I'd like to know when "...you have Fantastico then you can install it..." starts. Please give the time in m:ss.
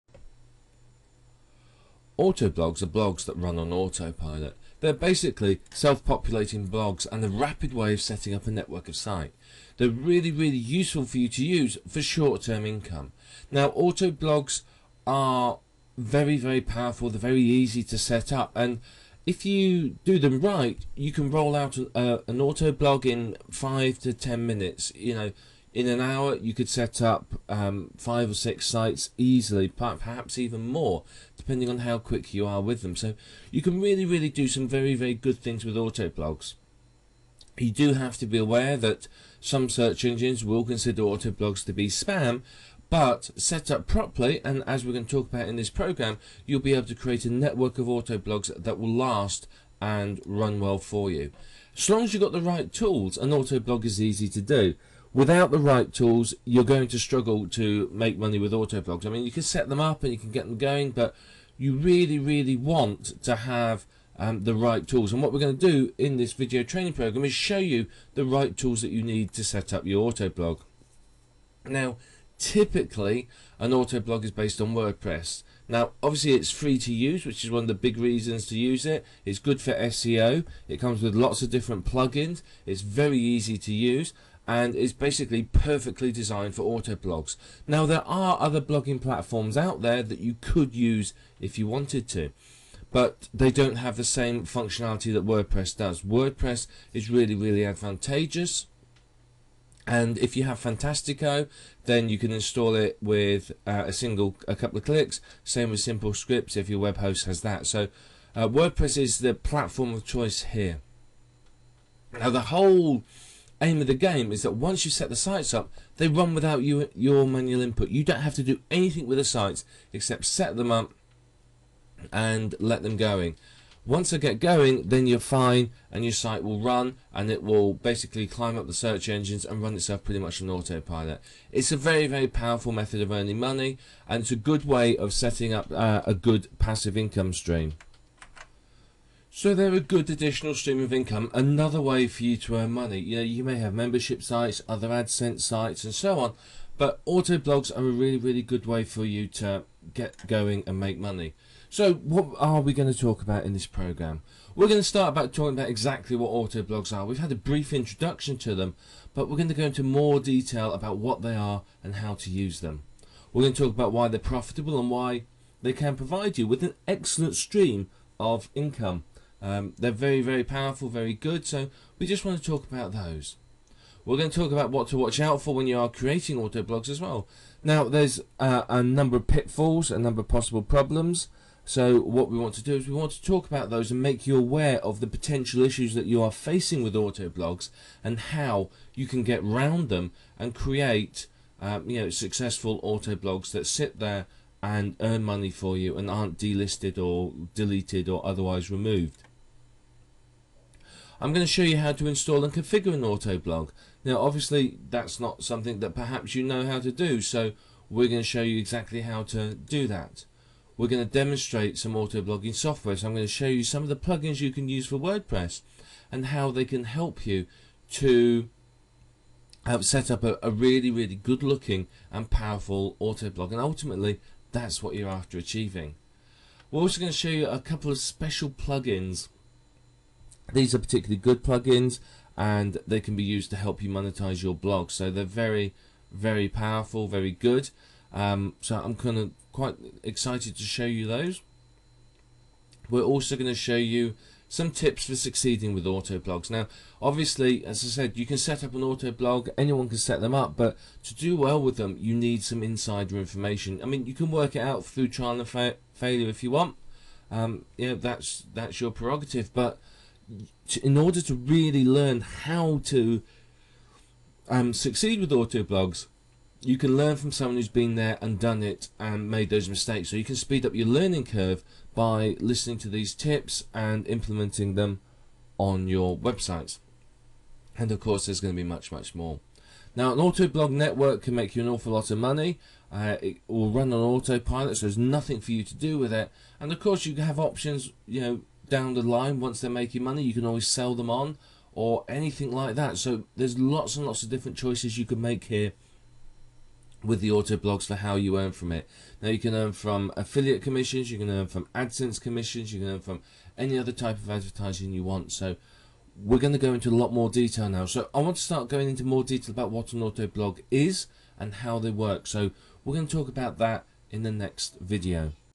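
1:40.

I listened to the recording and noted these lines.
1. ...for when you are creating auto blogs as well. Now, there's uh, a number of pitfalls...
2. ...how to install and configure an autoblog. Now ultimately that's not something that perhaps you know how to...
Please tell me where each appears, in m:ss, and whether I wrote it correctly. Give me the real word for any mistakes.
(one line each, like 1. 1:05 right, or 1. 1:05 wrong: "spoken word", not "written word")
1. 2:55 right
2. 3:21 wrong: "obviously", not "ultimately".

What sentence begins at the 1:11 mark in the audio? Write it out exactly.
Now, typically, an autoblog is based on WordPress.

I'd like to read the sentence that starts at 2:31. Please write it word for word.
So what are we going to talk about in this program?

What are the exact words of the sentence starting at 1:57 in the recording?
You don't have to do anything with the sites except set them up and let them going.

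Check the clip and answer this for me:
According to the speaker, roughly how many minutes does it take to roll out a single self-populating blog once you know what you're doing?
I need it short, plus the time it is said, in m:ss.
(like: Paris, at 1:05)
5 to 10 minutes, at 0:23.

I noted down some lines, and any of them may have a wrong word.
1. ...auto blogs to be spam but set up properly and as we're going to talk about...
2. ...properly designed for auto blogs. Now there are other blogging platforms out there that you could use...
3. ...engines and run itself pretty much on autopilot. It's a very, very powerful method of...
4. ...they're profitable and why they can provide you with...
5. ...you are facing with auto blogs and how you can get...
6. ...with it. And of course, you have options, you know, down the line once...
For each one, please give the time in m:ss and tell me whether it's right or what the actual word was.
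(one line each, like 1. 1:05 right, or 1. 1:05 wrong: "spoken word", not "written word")
1. 0:41 right
2. 1:25 wrong: "perfectly", not "properly"
3. 2:09 right
4. 2:44 right
5. 3:06 right
6. 4:45 right.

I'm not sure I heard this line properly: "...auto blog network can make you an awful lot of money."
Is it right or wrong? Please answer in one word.
right.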